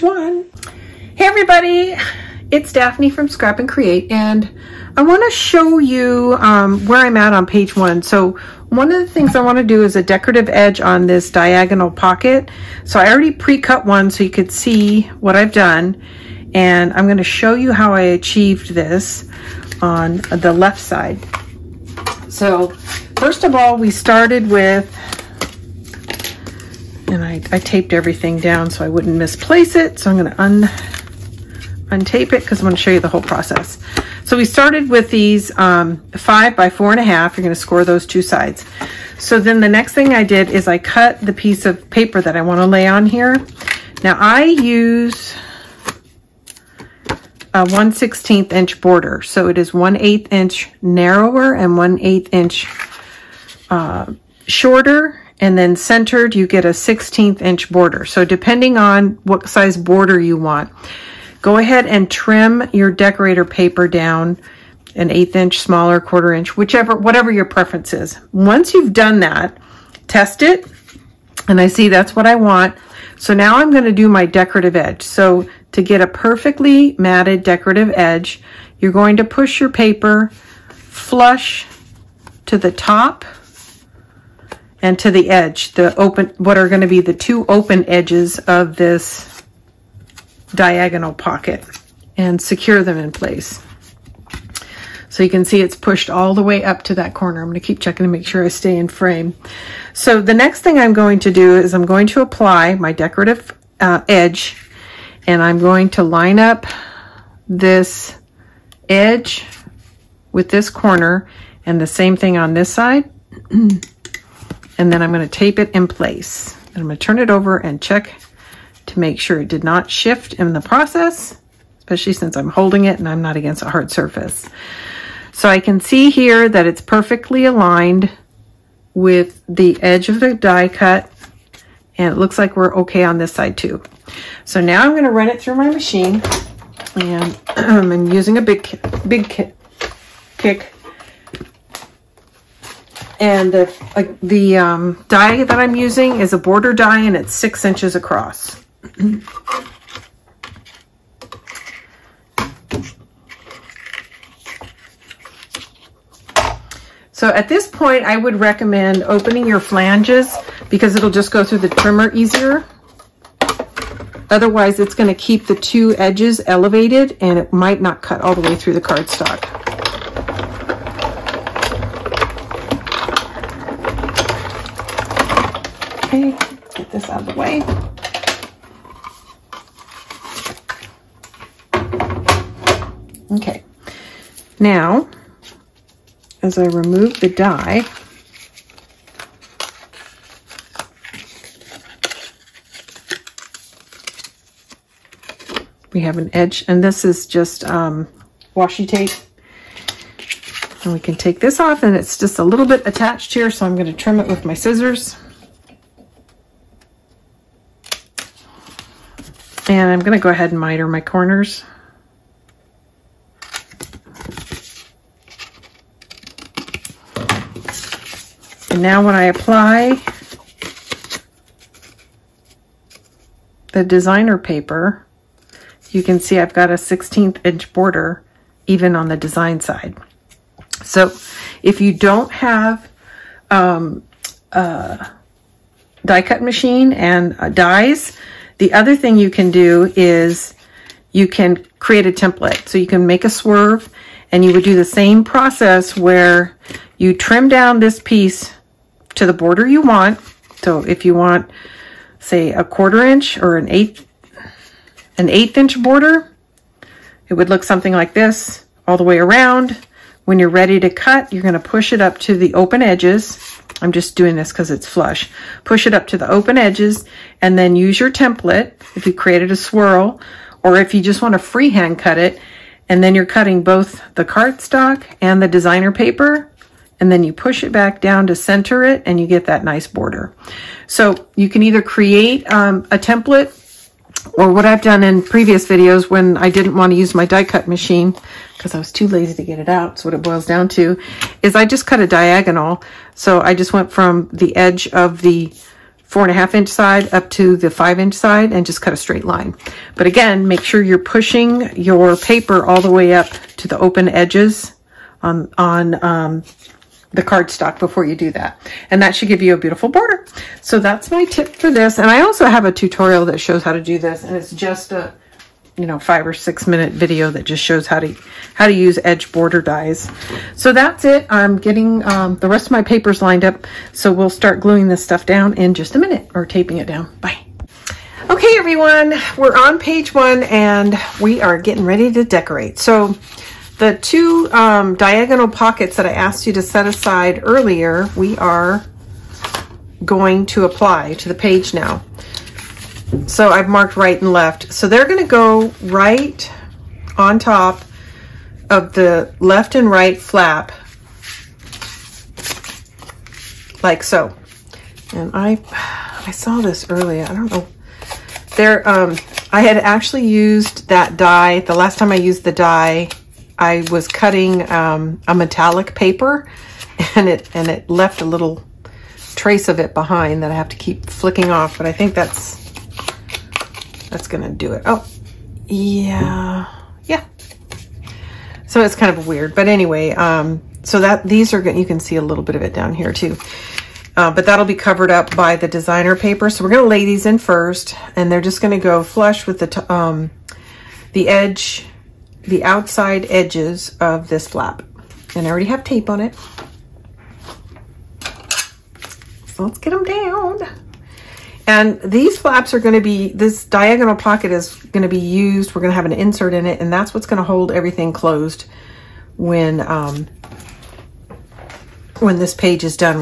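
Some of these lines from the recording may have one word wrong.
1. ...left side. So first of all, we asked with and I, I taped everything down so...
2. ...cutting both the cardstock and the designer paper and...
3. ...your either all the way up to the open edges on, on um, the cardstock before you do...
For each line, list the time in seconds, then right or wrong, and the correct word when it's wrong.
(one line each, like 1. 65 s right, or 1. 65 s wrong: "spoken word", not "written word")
1. 20 s wrong: "started", not "asked"
2. 273 s right
3. 301 s wrong: "paper", not "either".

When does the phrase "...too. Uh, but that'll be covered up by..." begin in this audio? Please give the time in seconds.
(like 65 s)
383 s.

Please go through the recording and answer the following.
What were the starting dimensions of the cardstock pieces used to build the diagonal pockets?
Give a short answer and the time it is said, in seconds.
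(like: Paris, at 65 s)
5 by 4 1/2, at 36 s.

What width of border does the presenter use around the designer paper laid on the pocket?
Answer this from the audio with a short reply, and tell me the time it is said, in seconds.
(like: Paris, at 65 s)
1/16 inch, at 47 s.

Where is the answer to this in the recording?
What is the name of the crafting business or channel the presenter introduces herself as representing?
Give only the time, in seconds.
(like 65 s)
3 s.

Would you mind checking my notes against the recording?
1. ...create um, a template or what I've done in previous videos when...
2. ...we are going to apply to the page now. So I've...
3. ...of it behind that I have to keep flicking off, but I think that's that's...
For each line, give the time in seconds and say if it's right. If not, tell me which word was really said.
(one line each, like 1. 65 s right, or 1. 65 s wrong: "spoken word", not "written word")
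1. 281 s right
2. 338 s right
3. 369 s right.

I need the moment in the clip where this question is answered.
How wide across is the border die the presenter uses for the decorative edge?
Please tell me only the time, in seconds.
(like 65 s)
147 s.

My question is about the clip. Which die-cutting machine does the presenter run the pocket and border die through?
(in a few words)
Big Kick.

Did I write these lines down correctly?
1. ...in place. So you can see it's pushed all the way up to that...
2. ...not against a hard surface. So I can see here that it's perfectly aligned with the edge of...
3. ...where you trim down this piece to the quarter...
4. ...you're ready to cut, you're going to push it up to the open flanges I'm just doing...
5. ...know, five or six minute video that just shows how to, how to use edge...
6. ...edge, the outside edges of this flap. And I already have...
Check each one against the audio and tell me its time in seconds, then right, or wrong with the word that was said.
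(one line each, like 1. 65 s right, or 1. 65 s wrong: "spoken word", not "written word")
1. 92 s right
2. 123 s right
3. 245 s wrong: "border", not "quarter"
4. 260 s wrong: "edges", not "flanges"
5. 315 s right
6. 391 s right.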